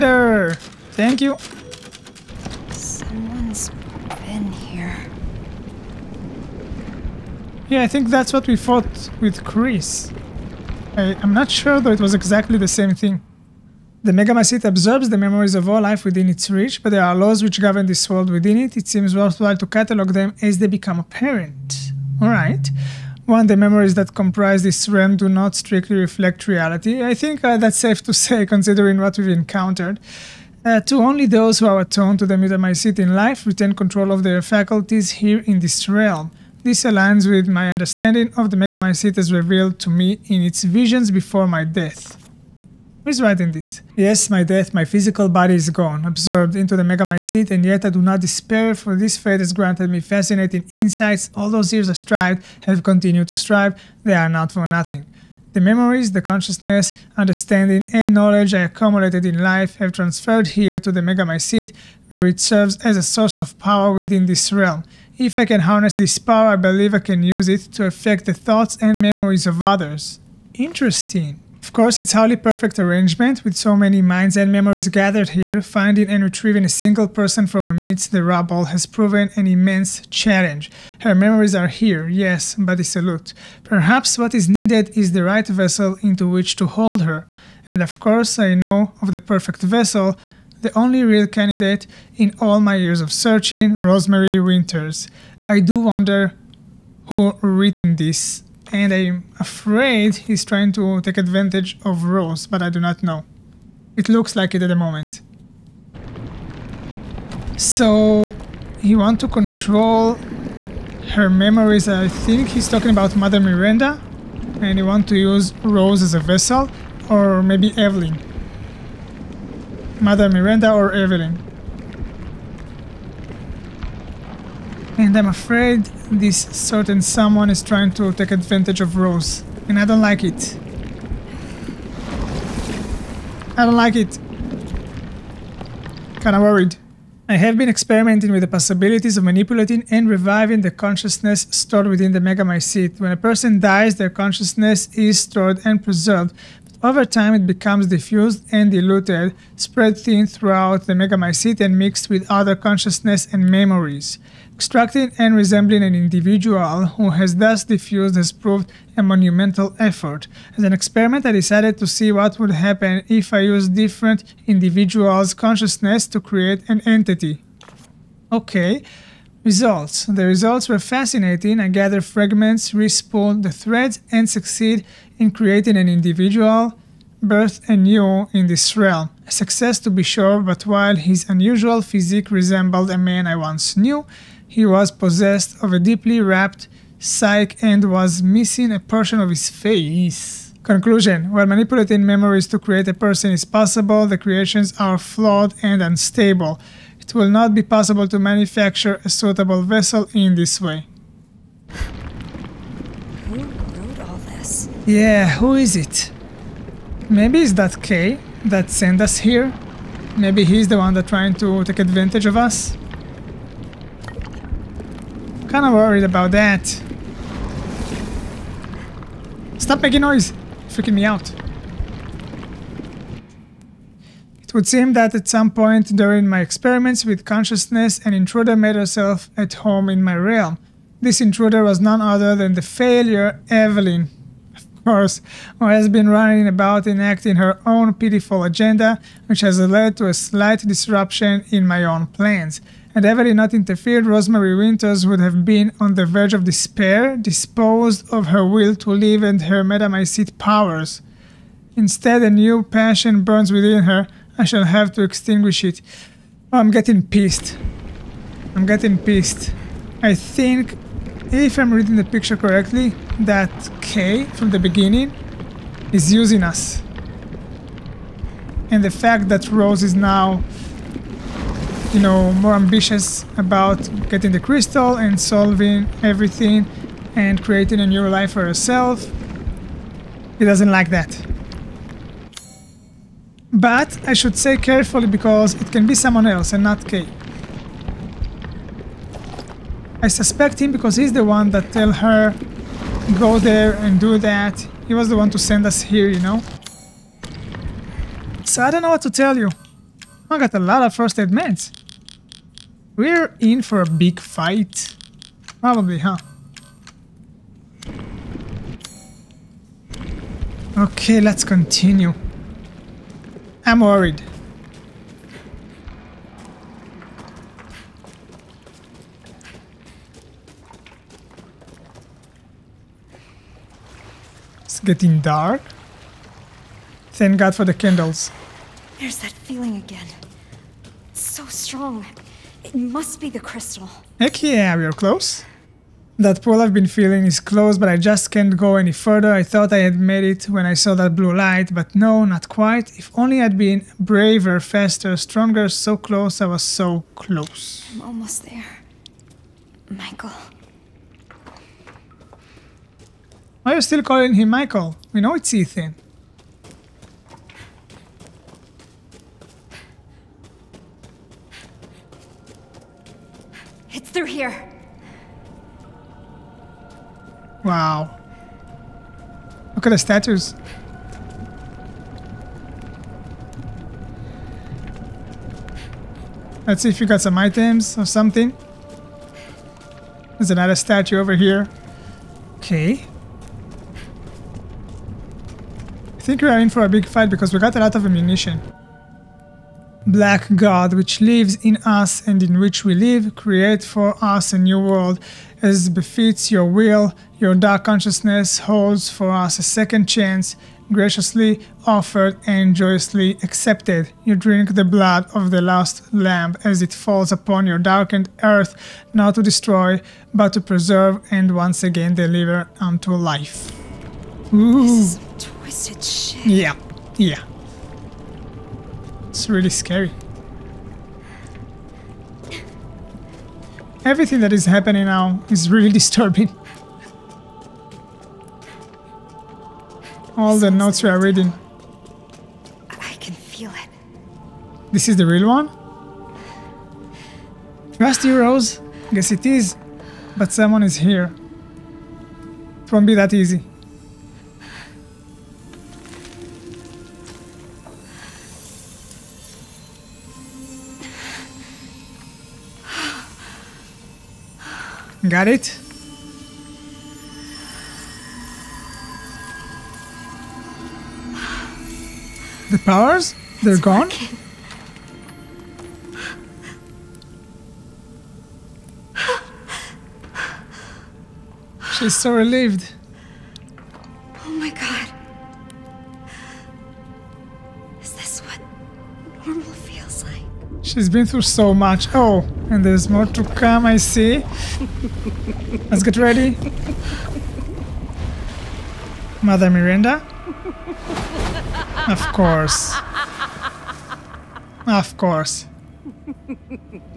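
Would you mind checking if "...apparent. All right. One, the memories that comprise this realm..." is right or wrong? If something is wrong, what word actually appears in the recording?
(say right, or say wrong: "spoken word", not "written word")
right.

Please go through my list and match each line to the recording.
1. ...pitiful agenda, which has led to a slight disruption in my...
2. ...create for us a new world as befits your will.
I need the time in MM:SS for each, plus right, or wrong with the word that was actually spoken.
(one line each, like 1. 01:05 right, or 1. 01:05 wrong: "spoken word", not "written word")
1. 03:57 right
2. 06:33 right.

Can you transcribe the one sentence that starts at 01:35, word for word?
I do wonder who written this and I'm afraid he's trying to take advantage of Rose, but I do not know.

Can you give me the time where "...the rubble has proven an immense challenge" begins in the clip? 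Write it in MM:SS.
01:18.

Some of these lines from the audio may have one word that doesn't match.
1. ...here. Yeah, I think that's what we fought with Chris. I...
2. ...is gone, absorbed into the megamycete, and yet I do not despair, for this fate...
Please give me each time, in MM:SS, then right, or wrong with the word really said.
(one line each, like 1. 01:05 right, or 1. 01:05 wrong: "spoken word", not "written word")
1. 00:04 right
2. 00:45 right.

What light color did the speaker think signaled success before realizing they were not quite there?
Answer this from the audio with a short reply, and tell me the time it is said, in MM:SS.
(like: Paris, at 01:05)
Blue, at 05:41.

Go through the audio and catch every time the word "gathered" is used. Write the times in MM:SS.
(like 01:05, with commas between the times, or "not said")
01:14, 02:51.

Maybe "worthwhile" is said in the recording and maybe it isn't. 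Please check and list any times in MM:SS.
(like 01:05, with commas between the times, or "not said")
00:19.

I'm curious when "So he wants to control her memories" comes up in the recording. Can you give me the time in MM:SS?
01:47.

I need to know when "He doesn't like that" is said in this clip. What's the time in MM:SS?
04:40.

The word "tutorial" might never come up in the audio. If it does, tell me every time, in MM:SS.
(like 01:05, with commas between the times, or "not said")
not said.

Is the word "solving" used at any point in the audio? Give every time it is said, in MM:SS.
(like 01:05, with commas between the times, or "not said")
04:35.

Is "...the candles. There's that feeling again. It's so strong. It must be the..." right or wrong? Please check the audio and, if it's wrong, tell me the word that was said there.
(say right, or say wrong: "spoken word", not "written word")
right.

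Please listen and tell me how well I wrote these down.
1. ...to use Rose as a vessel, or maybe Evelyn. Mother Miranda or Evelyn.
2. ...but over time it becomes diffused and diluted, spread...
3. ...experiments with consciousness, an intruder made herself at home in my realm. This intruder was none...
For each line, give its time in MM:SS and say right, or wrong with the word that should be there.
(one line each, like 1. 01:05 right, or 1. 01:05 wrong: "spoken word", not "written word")
1. 01:55 right
2. 02:26 right
3. 03:46 right.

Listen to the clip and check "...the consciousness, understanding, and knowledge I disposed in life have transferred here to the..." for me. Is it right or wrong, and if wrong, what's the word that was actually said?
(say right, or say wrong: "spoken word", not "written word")
wrong: "accumulated", not "disposed".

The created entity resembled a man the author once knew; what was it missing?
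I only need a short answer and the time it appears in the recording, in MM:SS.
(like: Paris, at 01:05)
A portion of his face, at 03:08.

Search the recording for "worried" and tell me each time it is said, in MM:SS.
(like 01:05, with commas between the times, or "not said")
02:16, 03:35, 05:13.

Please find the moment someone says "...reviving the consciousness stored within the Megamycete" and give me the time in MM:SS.
02:20.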